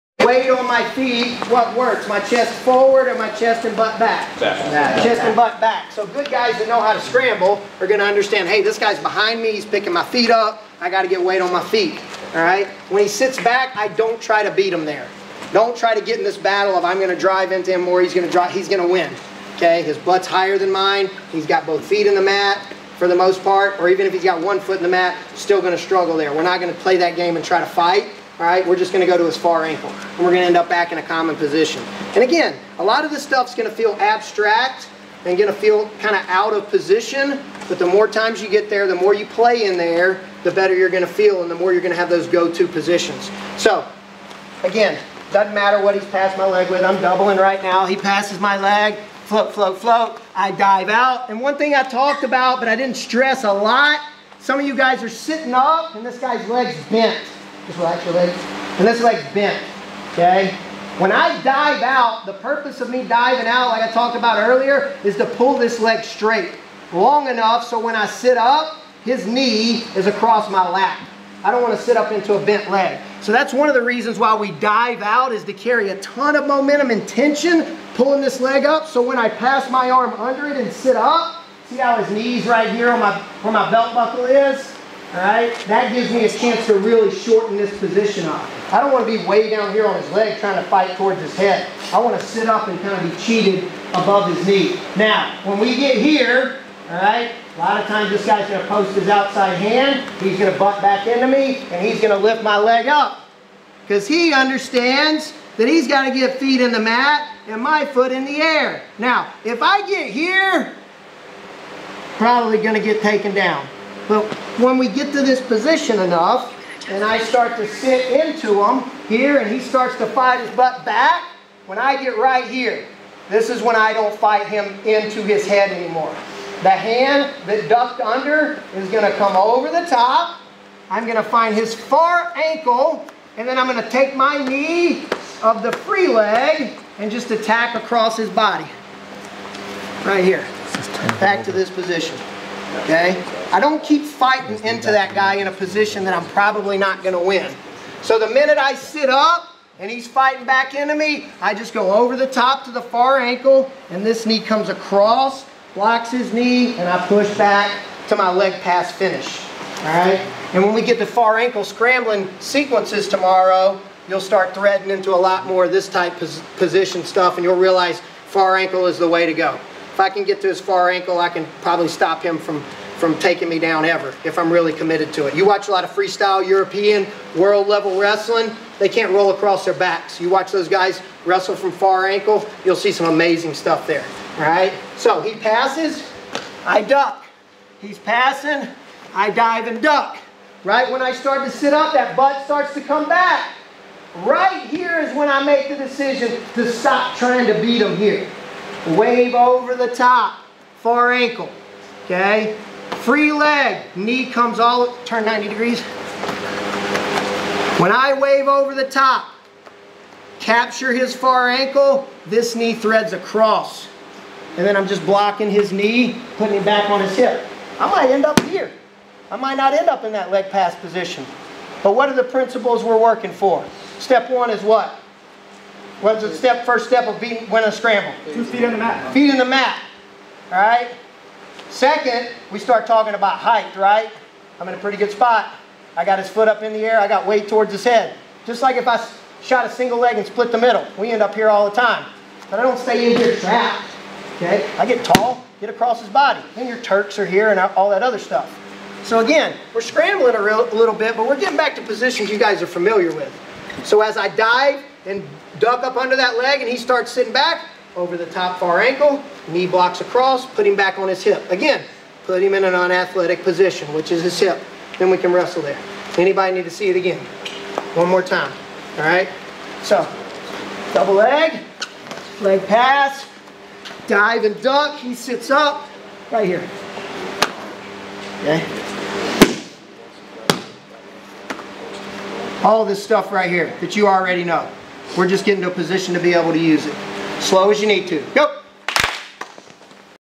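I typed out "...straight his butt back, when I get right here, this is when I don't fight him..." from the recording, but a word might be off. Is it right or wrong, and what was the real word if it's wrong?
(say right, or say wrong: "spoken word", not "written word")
wrong: "fight", not "straight".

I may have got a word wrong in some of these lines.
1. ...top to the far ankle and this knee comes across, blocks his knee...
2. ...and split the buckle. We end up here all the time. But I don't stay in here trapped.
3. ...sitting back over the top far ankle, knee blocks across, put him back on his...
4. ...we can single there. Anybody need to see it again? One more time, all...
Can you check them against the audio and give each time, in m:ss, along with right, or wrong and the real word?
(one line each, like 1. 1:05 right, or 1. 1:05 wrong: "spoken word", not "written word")
1. 2:32 right
2. 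4:00 wrong: "middle", not "buckle"
3. 4:17 right
4. 4:25 wrong: "wrestle", not "single".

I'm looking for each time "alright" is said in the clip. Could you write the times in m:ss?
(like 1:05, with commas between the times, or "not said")
1:25, 1:36.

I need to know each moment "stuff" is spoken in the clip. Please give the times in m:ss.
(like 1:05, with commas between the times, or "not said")
0:33, 2:47, 3:03, 4:08, 4:43.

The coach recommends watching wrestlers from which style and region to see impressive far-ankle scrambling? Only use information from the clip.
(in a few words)
freestyle European.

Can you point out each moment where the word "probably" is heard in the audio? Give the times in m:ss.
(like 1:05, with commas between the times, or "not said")
1:52, 2:26, 2:51.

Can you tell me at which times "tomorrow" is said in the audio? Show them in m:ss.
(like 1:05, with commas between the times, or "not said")
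2:43.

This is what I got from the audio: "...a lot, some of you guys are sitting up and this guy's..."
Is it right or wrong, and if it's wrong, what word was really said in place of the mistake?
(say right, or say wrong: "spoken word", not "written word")
right.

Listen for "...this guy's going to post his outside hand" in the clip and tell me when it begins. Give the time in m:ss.
1:38.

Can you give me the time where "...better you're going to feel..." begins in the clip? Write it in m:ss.
0:40.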